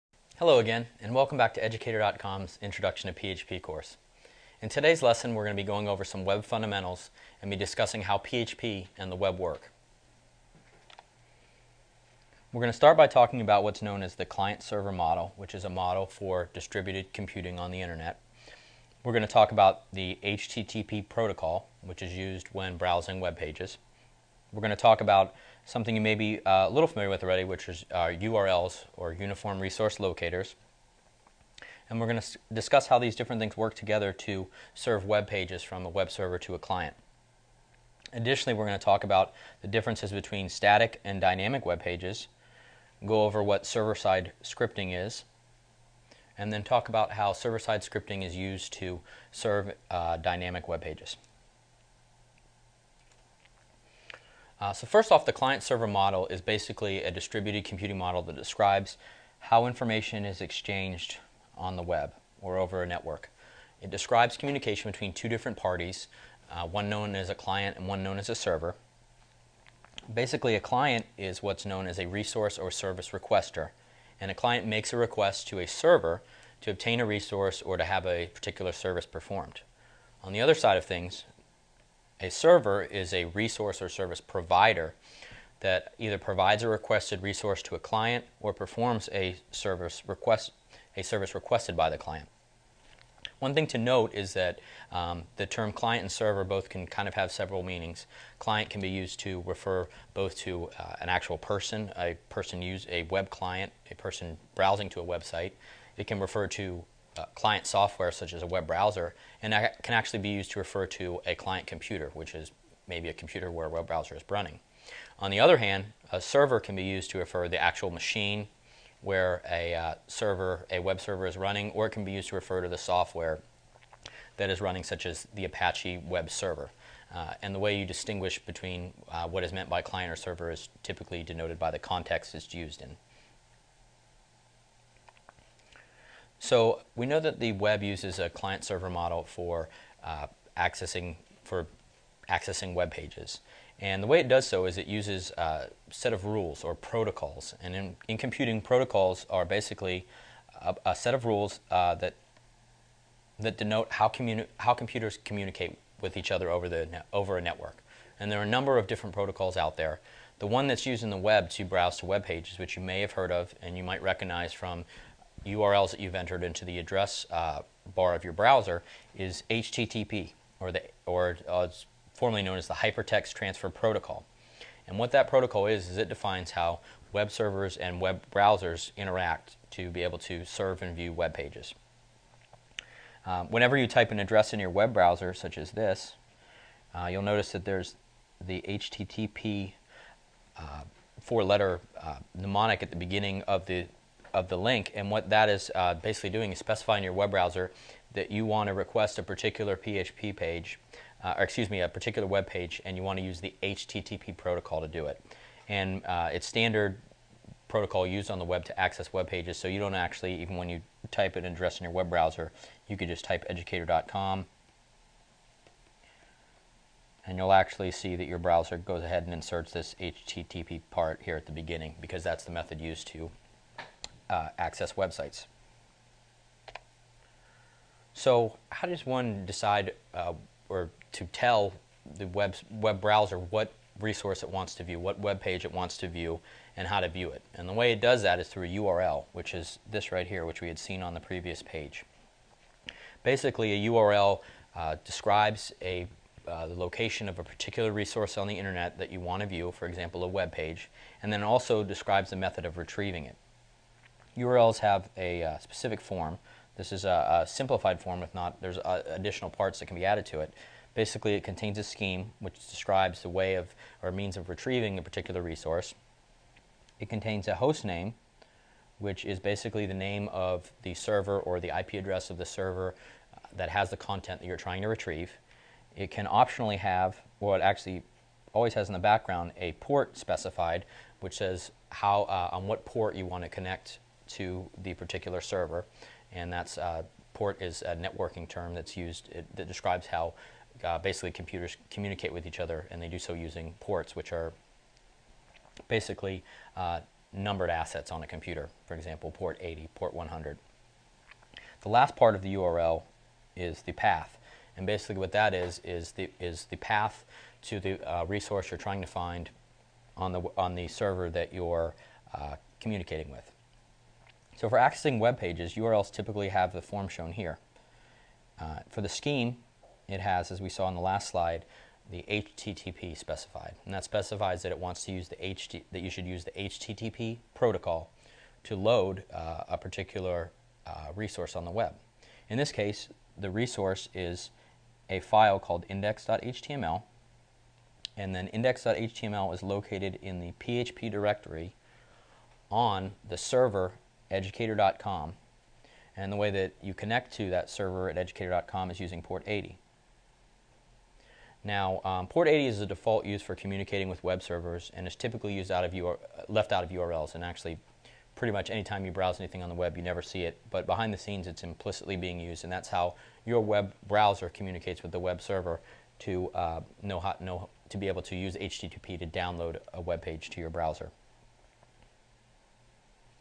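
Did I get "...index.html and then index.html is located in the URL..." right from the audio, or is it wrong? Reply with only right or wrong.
wrong.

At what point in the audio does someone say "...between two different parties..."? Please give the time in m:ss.
1:04.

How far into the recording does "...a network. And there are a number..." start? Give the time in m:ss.
2:37.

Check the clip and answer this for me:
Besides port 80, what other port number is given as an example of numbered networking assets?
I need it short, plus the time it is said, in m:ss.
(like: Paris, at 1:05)
100, at 4:59.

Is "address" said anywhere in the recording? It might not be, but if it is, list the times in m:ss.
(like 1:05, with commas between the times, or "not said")
2:46, 3:04, 3:31, 4:31.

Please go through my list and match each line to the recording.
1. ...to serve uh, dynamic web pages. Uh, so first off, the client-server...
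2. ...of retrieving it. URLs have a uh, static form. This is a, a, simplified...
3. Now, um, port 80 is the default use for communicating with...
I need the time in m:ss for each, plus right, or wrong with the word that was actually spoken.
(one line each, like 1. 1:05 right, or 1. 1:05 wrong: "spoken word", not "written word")
1. 0:48 right
2. 4:12 wrong: "specific", not "static"
3. 5:51 right.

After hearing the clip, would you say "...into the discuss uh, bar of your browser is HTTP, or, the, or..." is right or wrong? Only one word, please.
wrong.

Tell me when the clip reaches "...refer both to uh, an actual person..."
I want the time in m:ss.
1:39.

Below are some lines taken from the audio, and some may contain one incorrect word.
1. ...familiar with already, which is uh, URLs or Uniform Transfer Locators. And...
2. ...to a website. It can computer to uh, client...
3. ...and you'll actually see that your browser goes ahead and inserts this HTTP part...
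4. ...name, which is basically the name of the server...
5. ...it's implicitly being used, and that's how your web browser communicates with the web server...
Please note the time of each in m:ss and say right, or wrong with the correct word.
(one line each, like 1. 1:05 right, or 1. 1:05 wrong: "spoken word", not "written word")
1. 0:26 wrong: "Resource", not "Transfer"
2. 1:44 wrong: "refer", not "computer"
3. 3:37 right
4. 4:27 right
5. 6:01 right.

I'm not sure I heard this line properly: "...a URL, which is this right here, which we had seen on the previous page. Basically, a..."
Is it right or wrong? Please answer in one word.
right.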